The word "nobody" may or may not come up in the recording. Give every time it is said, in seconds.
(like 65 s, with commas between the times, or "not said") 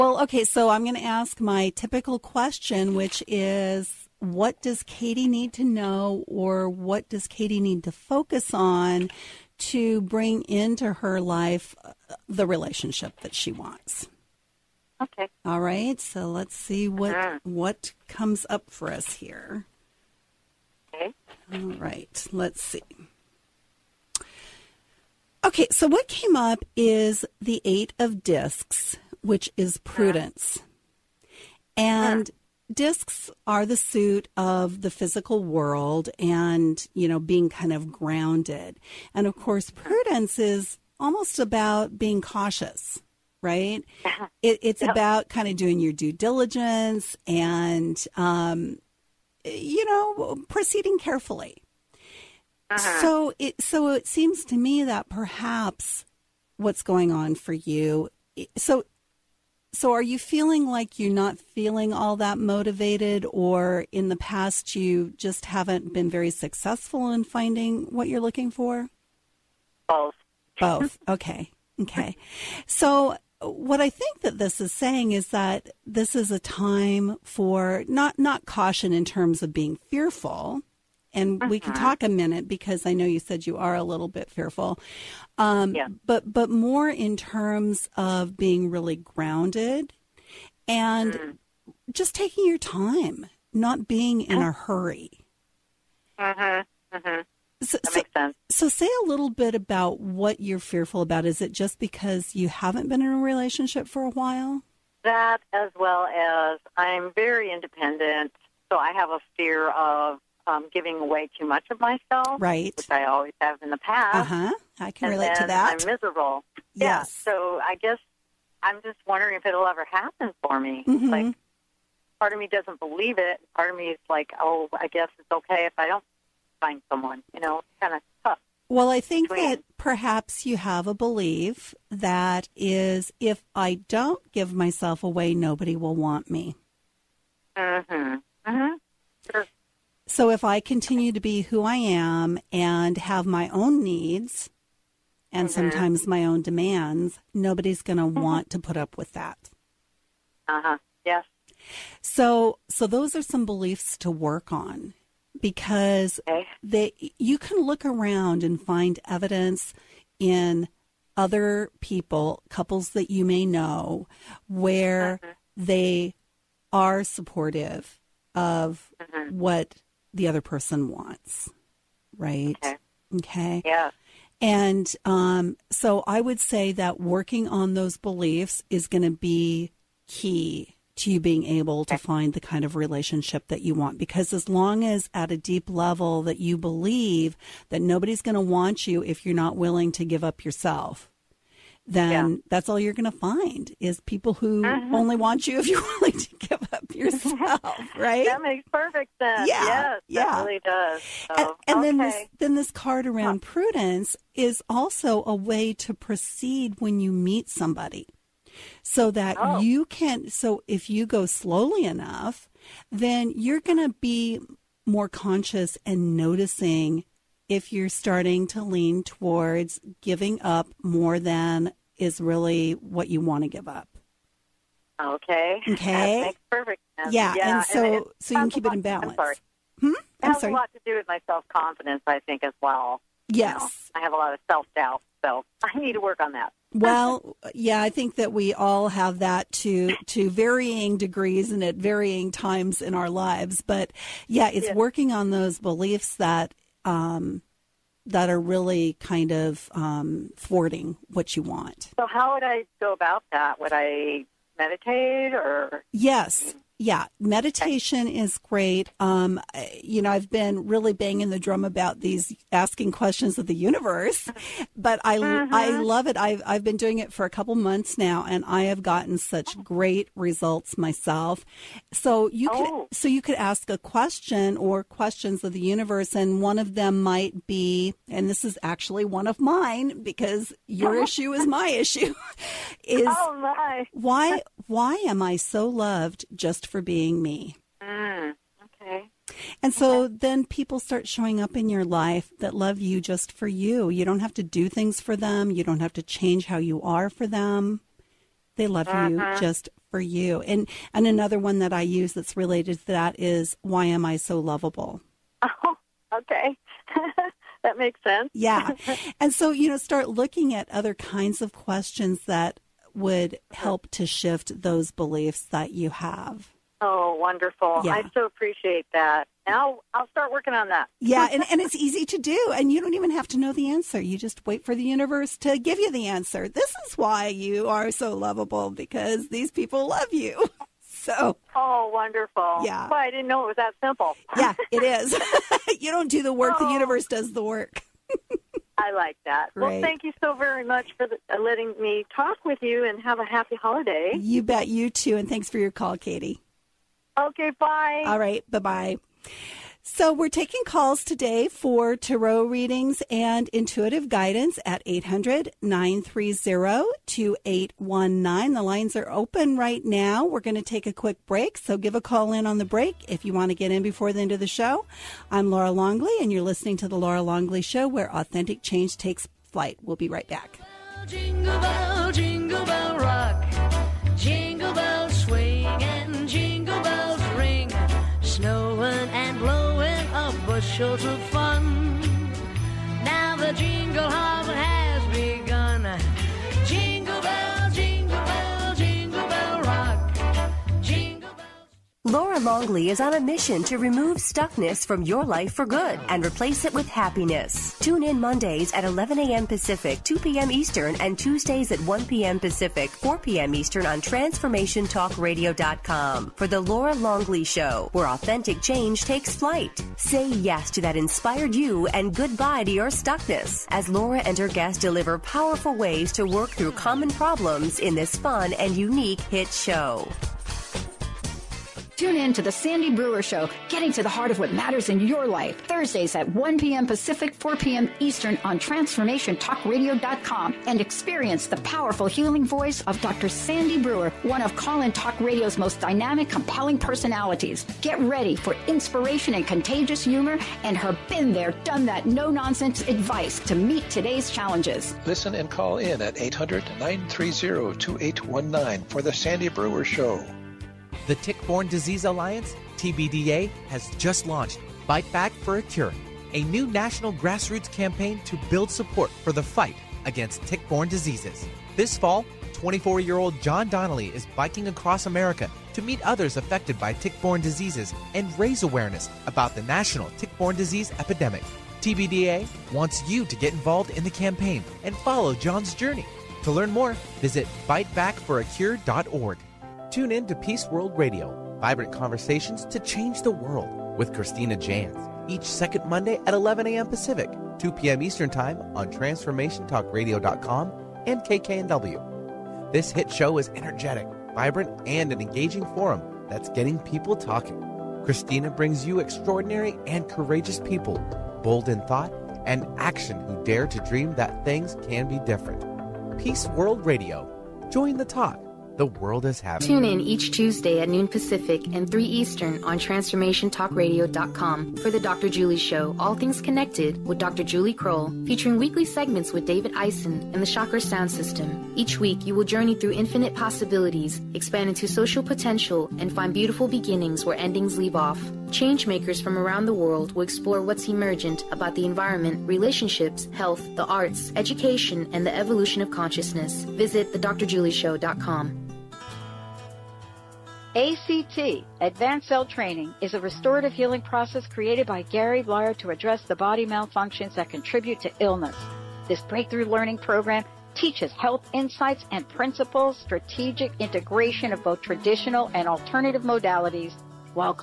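135 s, 147 s, 187 s.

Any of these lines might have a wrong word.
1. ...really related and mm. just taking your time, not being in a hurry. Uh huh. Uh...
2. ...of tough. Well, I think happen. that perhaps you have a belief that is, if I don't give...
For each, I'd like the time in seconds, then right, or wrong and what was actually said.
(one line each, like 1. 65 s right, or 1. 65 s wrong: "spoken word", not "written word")
1. 88 s wrong: "grounded", not "related"
2. 127 s wrong: "between", not "happen".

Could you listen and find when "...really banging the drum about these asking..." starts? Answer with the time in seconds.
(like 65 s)
260 s.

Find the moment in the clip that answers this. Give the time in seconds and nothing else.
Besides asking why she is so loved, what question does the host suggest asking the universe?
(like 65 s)
303 s.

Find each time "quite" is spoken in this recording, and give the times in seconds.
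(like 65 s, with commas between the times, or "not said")
not said.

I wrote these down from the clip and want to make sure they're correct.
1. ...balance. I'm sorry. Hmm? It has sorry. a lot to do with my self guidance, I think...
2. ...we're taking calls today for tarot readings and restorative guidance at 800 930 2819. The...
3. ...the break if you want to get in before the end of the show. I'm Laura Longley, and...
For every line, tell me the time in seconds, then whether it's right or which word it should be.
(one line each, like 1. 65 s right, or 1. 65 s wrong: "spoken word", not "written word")
1. 228 s wrong: "confidence", not "guidance"
2. 350 s wrong: "intuitive", not "restorative"
3. 362 s right.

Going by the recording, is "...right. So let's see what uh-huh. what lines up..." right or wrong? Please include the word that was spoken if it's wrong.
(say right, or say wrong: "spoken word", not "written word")
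wrong: "comes", not "lines".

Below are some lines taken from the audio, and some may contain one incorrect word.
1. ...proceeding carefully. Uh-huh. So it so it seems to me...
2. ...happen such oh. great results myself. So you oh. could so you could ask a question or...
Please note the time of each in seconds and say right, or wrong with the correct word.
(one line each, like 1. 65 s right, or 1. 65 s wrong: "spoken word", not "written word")
1. 50 s right
2. 268 s wrong: "gotten", not "happen".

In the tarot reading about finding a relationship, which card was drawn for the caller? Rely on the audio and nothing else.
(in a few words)
8 of discs.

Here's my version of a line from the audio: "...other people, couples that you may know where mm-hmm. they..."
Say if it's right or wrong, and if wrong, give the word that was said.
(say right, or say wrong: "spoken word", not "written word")
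right.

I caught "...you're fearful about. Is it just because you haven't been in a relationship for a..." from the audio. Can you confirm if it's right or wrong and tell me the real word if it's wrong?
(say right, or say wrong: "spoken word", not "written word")
right.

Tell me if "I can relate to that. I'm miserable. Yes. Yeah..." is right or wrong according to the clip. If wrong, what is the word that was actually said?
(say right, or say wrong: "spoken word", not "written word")
right.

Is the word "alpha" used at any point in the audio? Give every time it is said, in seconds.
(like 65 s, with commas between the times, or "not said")
not said.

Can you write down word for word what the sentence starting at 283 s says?
why why am I so loved just for being me.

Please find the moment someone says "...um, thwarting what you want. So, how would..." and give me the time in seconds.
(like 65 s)
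249 s.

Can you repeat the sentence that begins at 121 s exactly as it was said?
Like, part of me doesn't believe it.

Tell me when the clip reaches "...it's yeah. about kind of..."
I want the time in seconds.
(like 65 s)
44 s.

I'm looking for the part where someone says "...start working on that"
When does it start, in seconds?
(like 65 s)
320 s.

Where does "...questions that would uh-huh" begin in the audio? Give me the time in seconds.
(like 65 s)
311 s.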